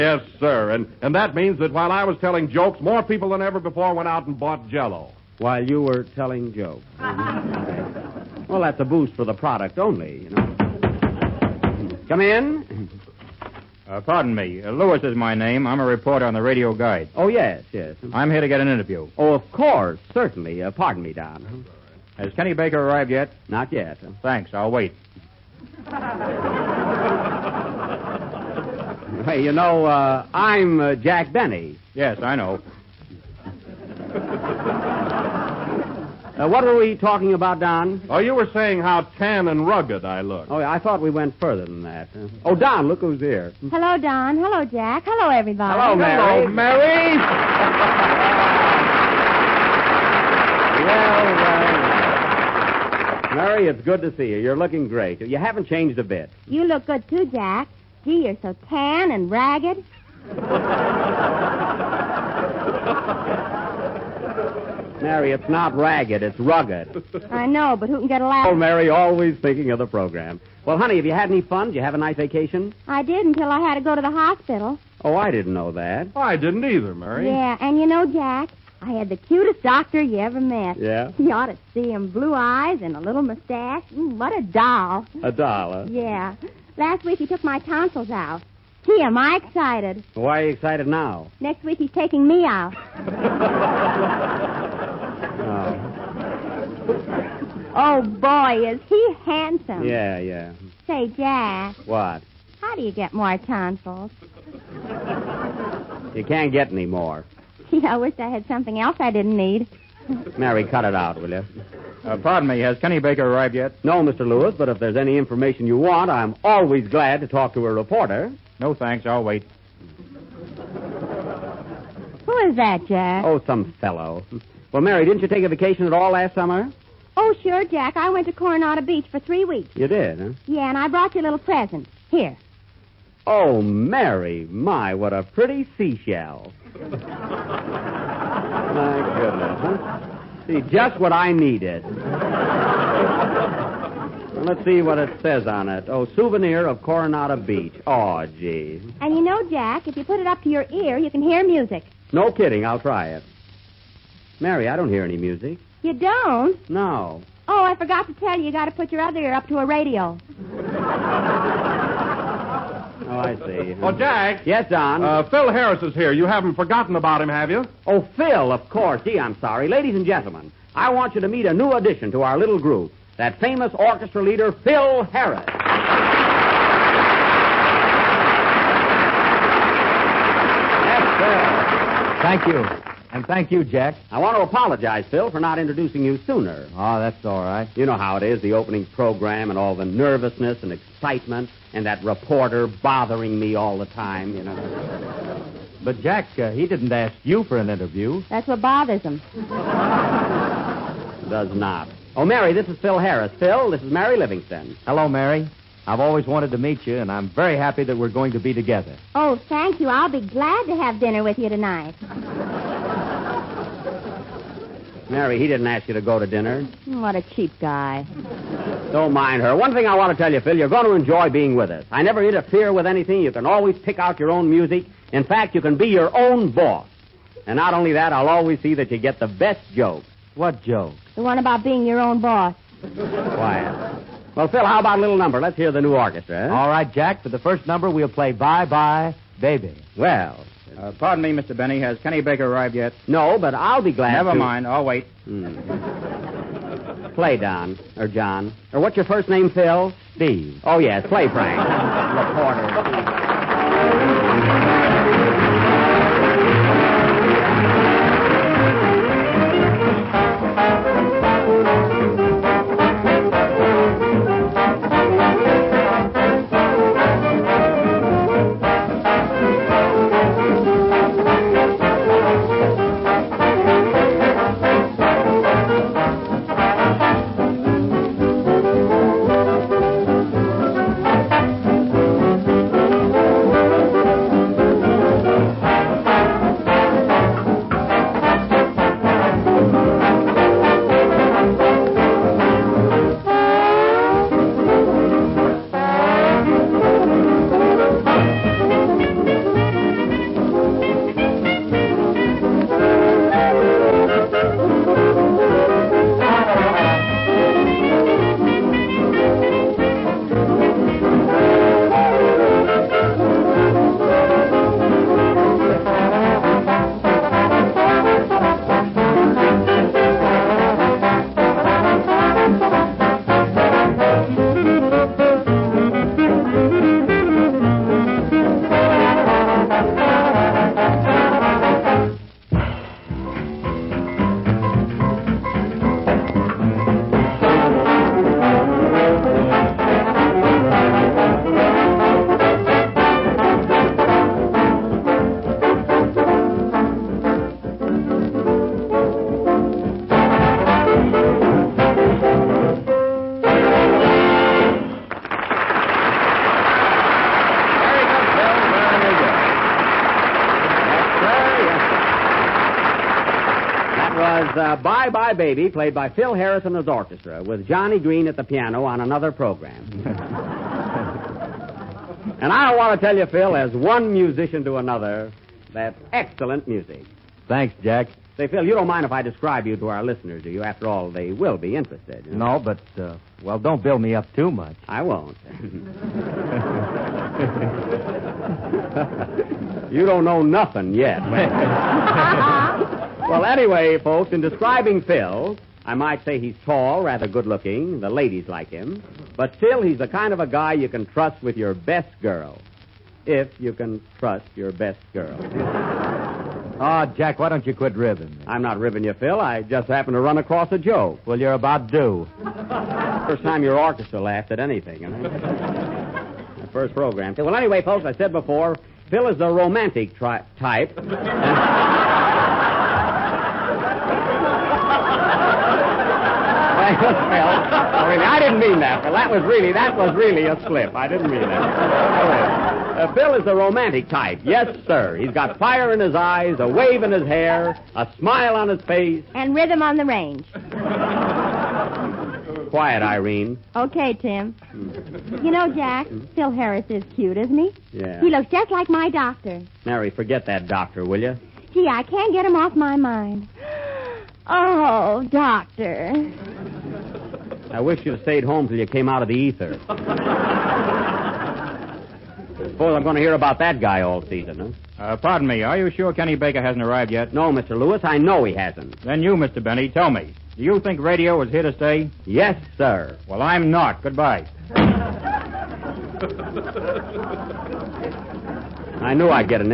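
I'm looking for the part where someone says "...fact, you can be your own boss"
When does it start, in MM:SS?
03:45.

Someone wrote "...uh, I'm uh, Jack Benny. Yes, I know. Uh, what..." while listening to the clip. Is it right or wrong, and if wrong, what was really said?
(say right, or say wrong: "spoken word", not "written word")
right.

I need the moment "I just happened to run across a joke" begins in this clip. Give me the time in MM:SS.
06:49.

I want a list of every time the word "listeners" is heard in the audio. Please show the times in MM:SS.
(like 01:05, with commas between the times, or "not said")
06:20.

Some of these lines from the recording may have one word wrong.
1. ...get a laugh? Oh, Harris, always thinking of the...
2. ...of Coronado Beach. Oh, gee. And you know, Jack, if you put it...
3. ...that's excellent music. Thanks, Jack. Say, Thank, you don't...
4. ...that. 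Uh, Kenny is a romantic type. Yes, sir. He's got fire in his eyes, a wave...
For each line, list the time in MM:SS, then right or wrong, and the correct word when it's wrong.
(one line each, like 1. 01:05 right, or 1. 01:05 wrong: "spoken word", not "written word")
1. 01:08 wrong: "Mary", not "Harris"
2. 02:26 right
3. 06:15 wrong: "Phil", not "Thank"
4. 07:11 wrong: "Phil", not "Kenny".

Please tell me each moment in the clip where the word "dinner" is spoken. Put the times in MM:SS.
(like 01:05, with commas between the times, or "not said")
03:30, 03:36.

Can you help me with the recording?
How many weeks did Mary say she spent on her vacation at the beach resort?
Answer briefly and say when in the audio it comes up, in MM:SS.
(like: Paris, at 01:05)
3, at 02:09.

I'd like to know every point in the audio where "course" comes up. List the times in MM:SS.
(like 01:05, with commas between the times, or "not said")
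00:19, 02:48.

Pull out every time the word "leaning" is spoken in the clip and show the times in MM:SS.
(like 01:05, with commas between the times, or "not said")
not said.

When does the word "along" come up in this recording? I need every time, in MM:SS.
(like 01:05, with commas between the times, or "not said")
not said.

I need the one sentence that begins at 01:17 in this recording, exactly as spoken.
Yeah, and you know, Jack, I had the cutest doctor you ever met.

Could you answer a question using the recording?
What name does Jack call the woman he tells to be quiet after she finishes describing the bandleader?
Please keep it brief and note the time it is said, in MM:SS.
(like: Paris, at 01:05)
Irene, at 07:22.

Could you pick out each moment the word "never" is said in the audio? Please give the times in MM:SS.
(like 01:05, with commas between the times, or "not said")
03:42, 04:04.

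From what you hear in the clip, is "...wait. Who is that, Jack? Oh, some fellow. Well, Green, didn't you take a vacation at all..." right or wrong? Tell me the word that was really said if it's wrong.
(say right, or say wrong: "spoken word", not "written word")
wrong: "Mary", not "Green".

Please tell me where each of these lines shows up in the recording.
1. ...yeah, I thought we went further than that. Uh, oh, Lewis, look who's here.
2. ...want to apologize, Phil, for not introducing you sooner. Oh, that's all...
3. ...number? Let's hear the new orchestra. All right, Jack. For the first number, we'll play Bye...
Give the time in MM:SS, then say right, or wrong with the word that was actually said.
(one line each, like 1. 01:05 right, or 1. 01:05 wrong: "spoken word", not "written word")
1. 00:40 wrong: "Don", not "Lewis"
2. 03:04 right
3. 03:55 right.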